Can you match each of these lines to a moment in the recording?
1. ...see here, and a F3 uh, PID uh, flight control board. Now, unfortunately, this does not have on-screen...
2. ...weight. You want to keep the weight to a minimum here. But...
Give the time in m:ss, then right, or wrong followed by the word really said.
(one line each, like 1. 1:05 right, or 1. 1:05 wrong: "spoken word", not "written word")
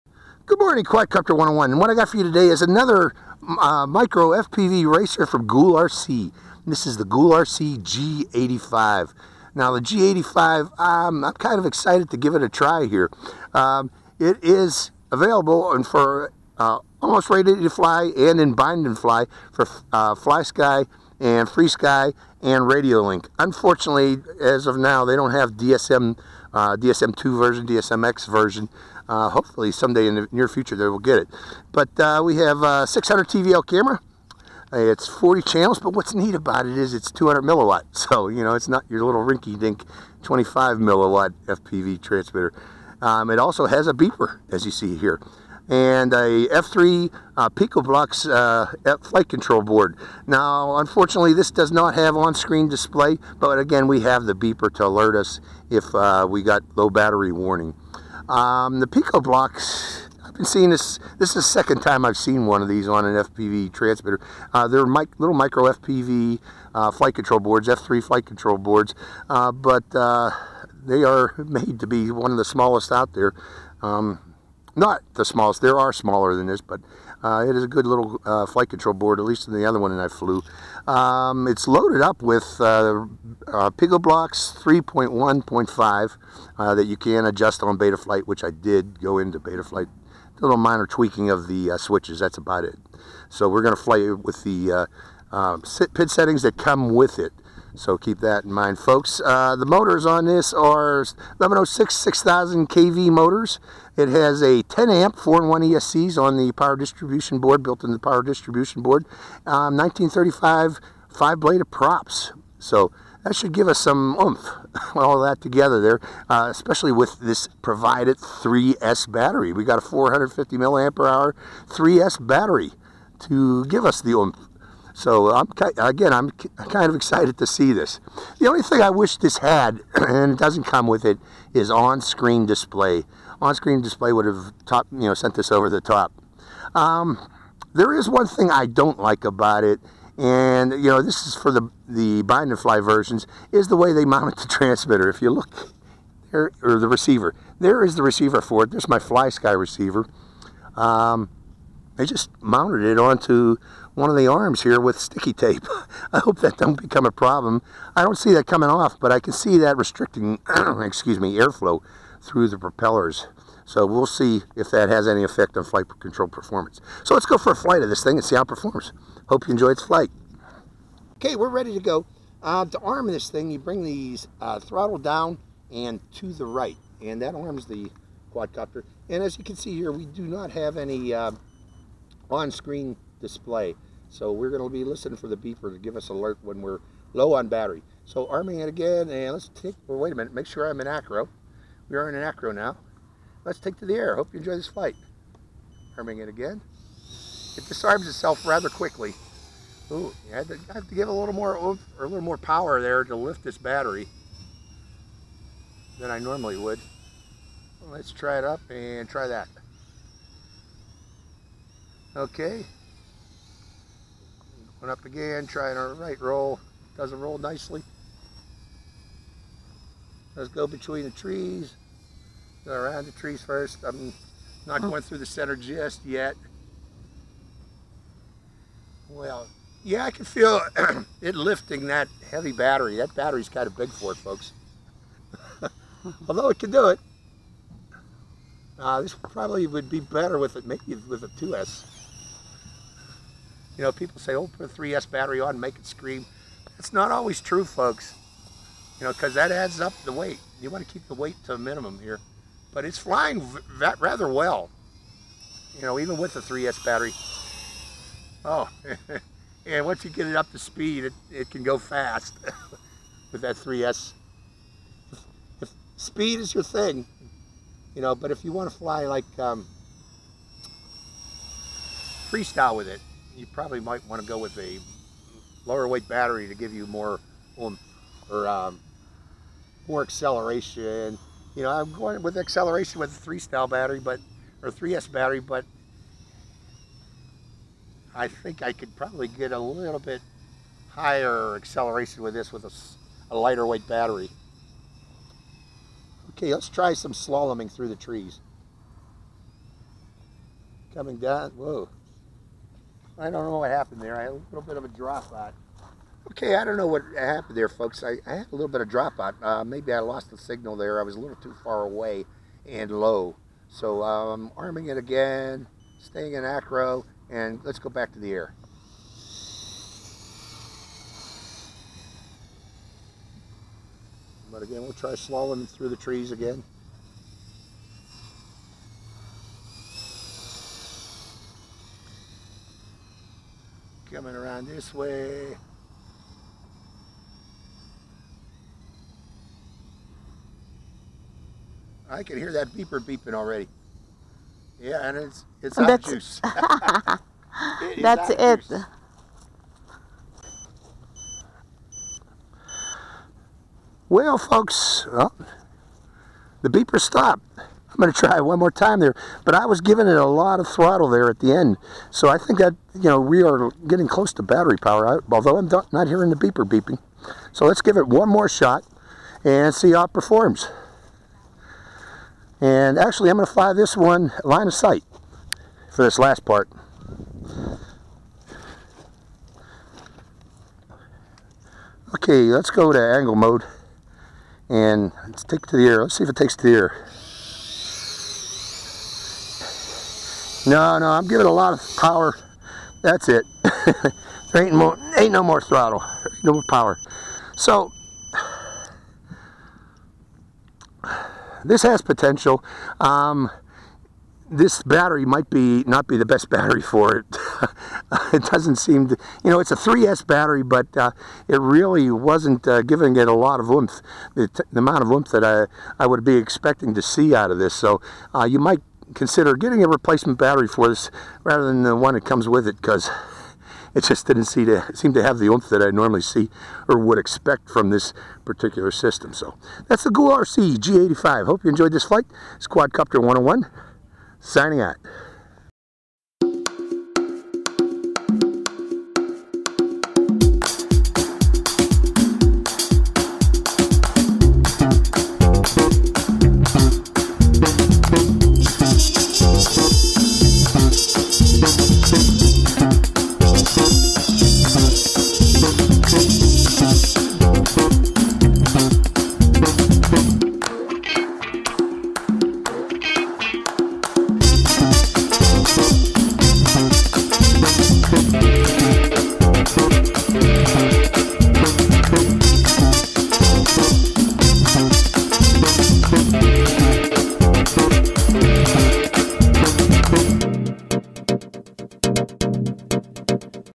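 1. 0:44 wrong: "PIKOBLX", not "PID"
2. 4:10 right.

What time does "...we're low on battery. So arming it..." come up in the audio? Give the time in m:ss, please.
3:06.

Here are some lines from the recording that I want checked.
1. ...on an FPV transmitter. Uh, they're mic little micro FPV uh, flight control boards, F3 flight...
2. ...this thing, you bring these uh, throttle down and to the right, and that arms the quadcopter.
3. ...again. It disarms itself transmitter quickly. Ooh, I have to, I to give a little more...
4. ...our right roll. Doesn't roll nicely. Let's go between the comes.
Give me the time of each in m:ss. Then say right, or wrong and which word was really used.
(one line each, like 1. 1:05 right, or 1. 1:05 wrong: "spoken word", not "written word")
1. 1:02 right
2. 2:53 right
3. 3:16 wrong: "rather", not "transmitter"
4. 3:35 wrong: "trees", not "comes".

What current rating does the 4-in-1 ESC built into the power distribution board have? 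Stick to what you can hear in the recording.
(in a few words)
10 amp.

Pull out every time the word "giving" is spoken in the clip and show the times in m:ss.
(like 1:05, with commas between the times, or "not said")
5:59, 6:31, 6:52.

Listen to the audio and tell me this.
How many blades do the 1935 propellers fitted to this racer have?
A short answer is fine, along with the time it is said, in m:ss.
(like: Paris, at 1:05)
five, at 1:51.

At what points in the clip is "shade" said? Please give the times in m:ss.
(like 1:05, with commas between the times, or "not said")
not said.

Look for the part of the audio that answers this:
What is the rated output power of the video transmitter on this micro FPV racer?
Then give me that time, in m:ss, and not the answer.
0:37.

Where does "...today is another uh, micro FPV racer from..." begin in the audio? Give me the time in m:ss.
0:02.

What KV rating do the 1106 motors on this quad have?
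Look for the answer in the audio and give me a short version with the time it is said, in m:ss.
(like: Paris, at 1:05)
6000 kV, at 1:41.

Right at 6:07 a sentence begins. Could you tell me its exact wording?
So let's give it one more shot and see how it performs.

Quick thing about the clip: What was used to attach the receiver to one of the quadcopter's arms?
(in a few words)
sticky tape.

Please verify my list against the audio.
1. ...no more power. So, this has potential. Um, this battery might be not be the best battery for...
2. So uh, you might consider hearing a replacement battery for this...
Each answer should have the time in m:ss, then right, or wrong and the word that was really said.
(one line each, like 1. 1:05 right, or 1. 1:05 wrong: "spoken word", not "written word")
1. 6:36 right
2. 6:57 wrong: "getting", not "hearing".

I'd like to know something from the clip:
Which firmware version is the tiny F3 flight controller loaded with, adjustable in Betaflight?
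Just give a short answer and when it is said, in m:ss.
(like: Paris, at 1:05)
3.1.5, at 1:24.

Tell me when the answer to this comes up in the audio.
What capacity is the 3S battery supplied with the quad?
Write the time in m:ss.
1:59.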